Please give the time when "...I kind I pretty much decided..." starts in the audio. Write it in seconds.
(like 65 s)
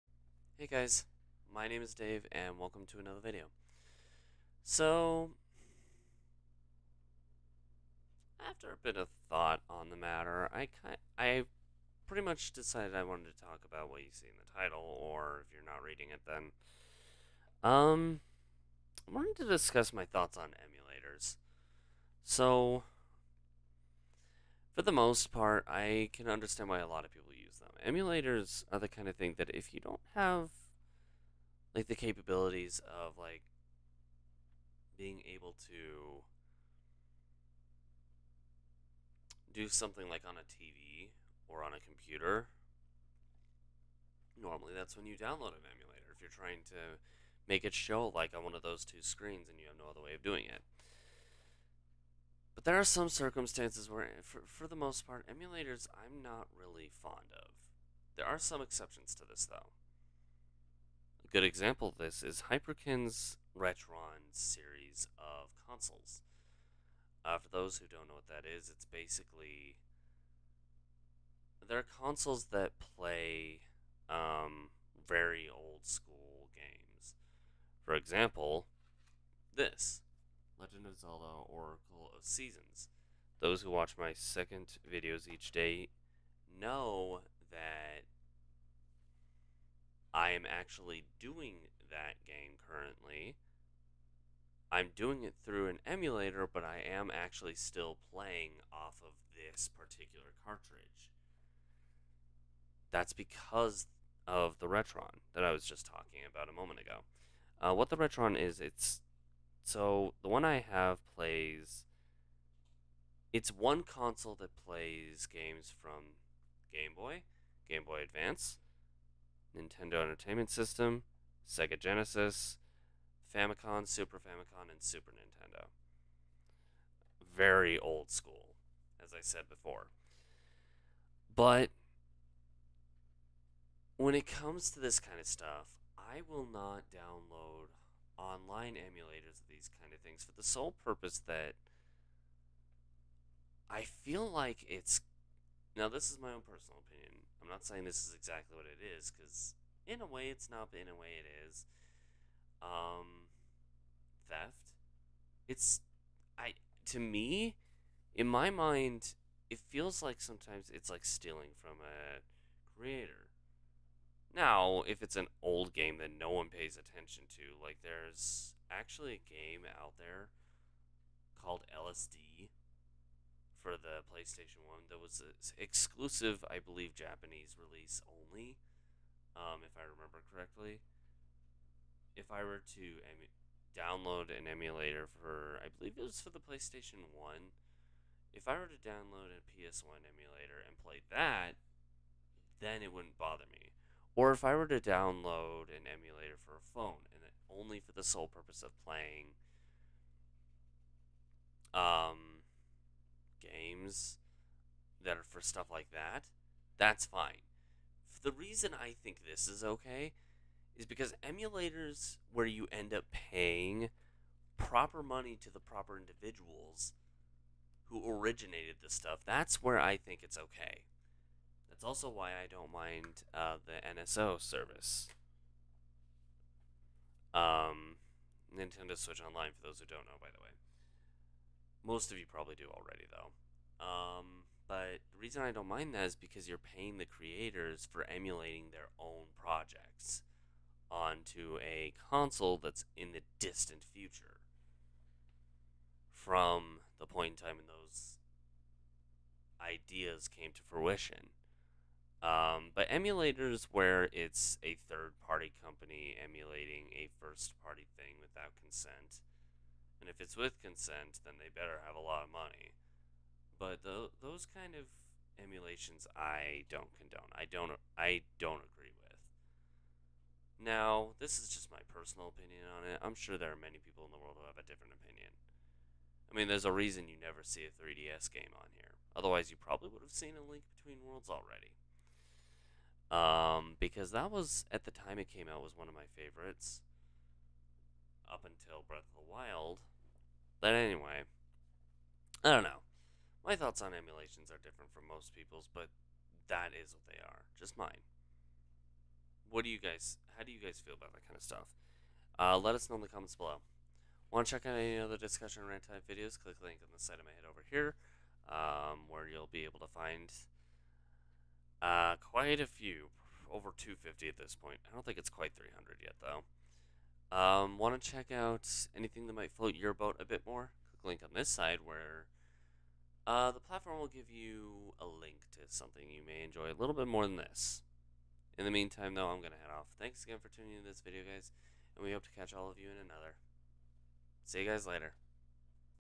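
10 s.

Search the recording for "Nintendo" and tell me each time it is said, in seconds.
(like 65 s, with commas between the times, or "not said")
119 s, 125 s, 228 s.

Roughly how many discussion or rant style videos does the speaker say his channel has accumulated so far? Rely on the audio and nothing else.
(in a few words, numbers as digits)
over 250.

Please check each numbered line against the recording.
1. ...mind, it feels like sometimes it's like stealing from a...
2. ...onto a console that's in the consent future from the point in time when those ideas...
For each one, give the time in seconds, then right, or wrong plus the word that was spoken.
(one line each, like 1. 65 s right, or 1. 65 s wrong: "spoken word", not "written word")
1. 158 s right
2. 240 s wrong: "distant", not "consent".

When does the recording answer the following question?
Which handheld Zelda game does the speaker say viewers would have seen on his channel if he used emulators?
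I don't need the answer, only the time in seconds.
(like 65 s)
280 s.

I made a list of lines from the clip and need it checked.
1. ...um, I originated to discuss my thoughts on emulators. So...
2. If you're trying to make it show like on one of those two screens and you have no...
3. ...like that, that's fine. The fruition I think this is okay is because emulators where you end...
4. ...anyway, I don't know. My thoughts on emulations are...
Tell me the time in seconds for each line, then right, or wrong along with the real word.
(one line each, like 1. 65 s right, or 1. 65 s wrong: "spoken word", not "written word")
1. 17 s wrong: "wanted", not "originated"
2. 46 s right
3. 205 s wrong: "reason", not "fruition"
4. 290 s right.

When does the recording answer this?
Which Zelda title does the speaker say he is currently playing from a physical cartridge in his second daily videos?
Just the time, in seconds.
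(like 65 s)
81 s.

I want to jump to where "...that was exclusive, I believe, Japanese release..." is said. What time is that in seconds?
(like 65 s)
174 s.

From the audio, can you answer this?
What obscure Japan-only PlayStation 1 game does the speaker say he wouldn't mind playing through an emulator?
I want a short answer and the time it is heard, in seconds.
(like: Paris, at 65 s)
LSD, at 171 s.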